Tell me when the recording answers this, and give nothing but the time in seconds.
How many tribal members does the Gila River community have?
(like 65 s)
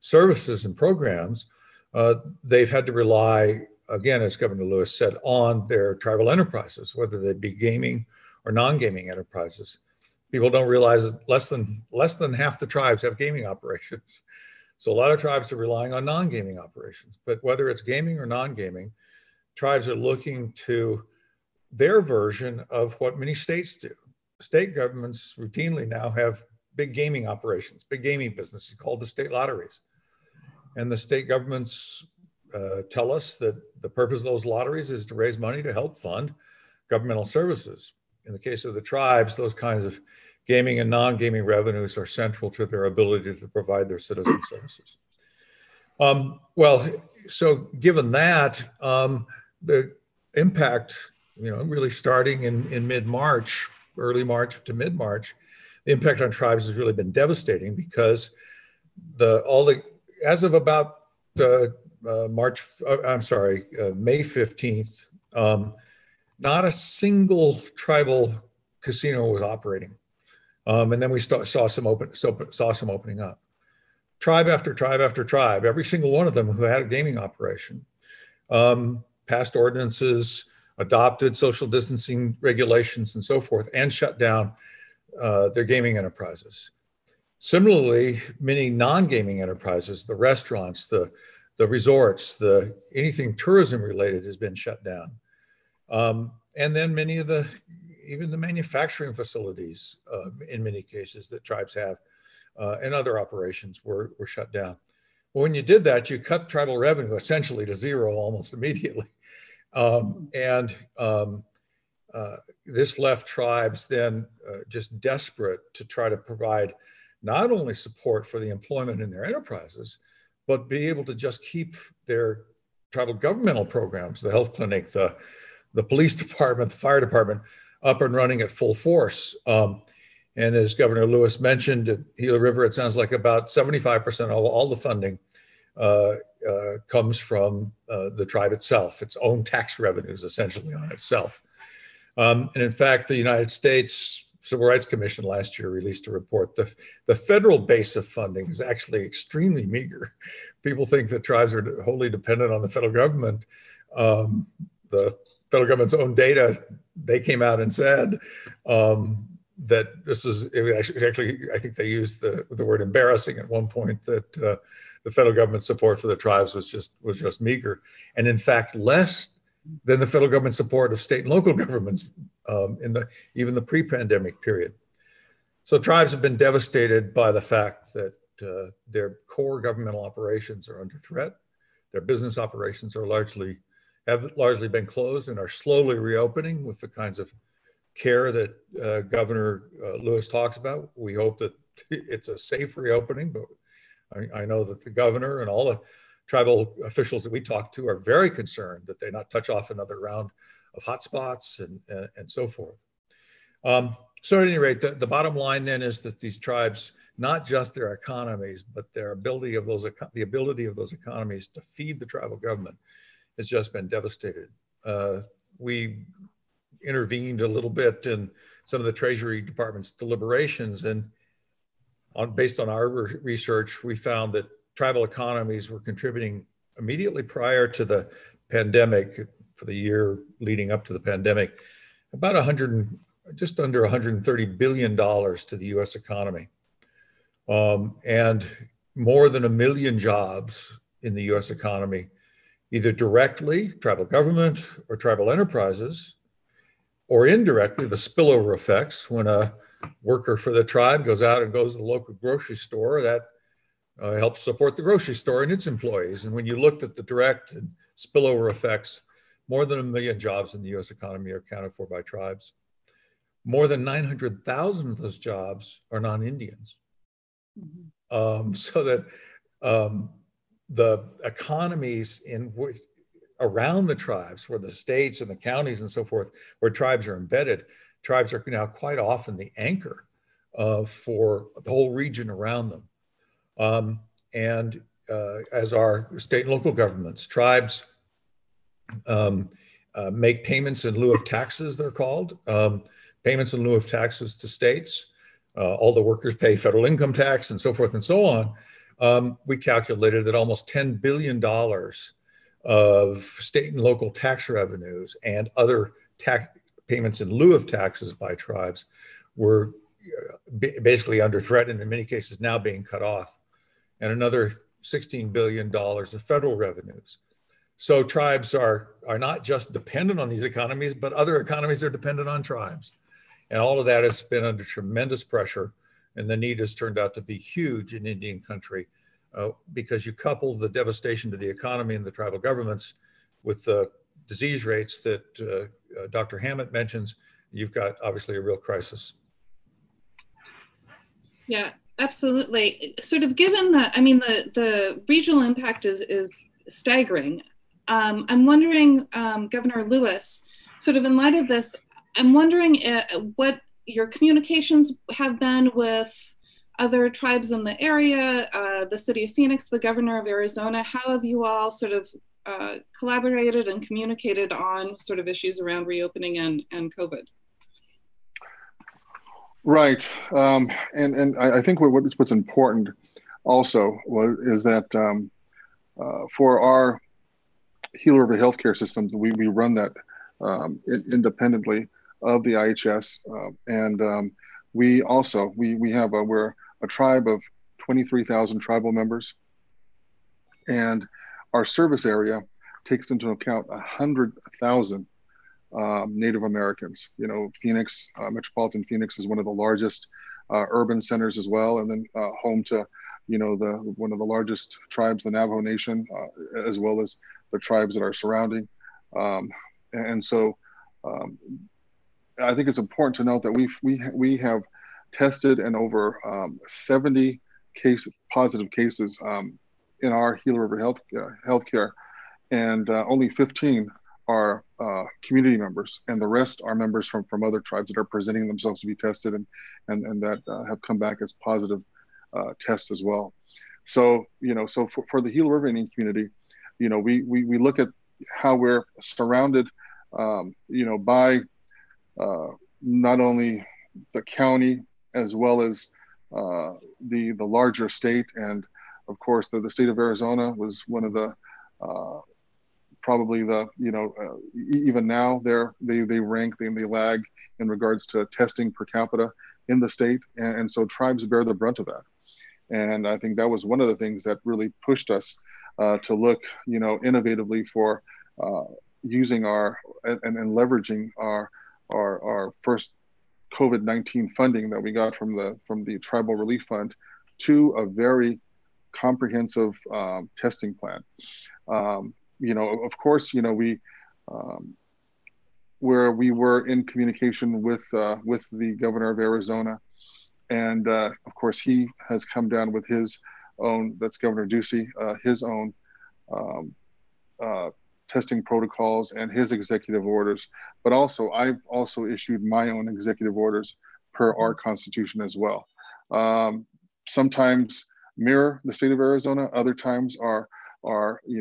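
387 s.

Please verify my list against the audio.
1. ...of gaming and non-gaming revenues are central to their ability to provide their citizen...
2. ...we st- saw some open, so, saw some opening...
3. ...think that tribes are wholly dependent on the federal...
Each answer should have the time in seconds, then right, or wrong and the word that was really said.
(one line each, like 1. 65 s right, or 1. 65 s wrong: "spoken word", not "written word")
1. 39 s right
2. 71 s right
3. 150 s right.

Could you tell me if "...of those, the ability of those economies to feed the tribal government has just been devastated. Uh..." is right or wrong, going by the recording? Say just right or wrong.
right.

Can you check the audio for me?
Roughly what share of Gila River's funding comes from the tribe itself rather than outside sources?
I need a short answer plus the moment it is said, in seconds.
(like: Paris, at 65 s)
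75%, at 133 s.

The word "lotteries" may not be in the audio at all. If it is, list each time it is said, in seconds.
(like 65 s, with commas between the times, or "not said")
29 s, 34 s.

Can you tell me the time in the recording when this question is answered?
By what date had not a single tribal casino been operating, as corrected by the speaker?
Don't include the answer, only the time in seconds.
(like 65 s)
63 s.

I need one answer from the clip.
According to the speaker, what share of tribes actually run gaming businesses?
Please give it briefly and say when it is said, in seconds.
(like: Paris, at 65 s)
less than half, at 11 s.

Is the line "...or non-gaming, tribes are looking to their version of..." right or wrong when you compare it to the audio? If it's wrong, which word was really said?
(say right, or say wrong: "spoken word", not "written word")
right.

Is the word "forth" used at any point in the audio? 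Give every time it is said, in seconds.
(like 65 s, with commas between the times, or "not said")
83 s, 202 s, 276 s, 297 s.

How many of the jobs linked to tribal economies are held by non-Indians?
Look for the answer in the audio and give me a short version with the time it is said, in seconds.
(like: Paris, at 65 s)
more than 900,000, at 263 s.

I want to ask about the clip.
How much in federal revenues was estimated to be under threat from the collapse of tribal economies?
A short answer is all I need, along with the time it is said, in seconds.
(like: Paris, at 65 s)
$16 billion, at 314 s.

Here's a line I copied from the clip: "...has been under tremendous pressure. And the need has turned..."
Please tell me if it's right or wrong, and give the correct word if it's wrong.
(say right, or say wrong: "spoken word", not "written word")
right.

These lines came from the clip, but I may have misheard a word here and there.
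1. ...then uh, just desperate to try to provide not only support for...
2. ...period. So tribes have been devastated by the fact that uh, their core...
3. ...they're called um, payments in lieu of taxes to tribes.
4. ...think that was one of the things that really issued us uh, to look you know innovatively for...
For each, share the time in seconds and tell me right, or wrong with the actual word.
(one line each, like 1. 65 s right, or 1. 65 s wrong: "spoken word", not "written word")
1. 113 s right
2. 174 s right
3. 291 s wrong: "states", not "tribes"
4. 463 s wrong: "pushed", not "issued".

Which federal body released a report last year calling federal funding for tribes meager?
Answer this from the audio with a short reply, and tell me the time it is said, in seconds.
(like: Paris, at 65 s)
United States Civil Rights Commission, at 143 s.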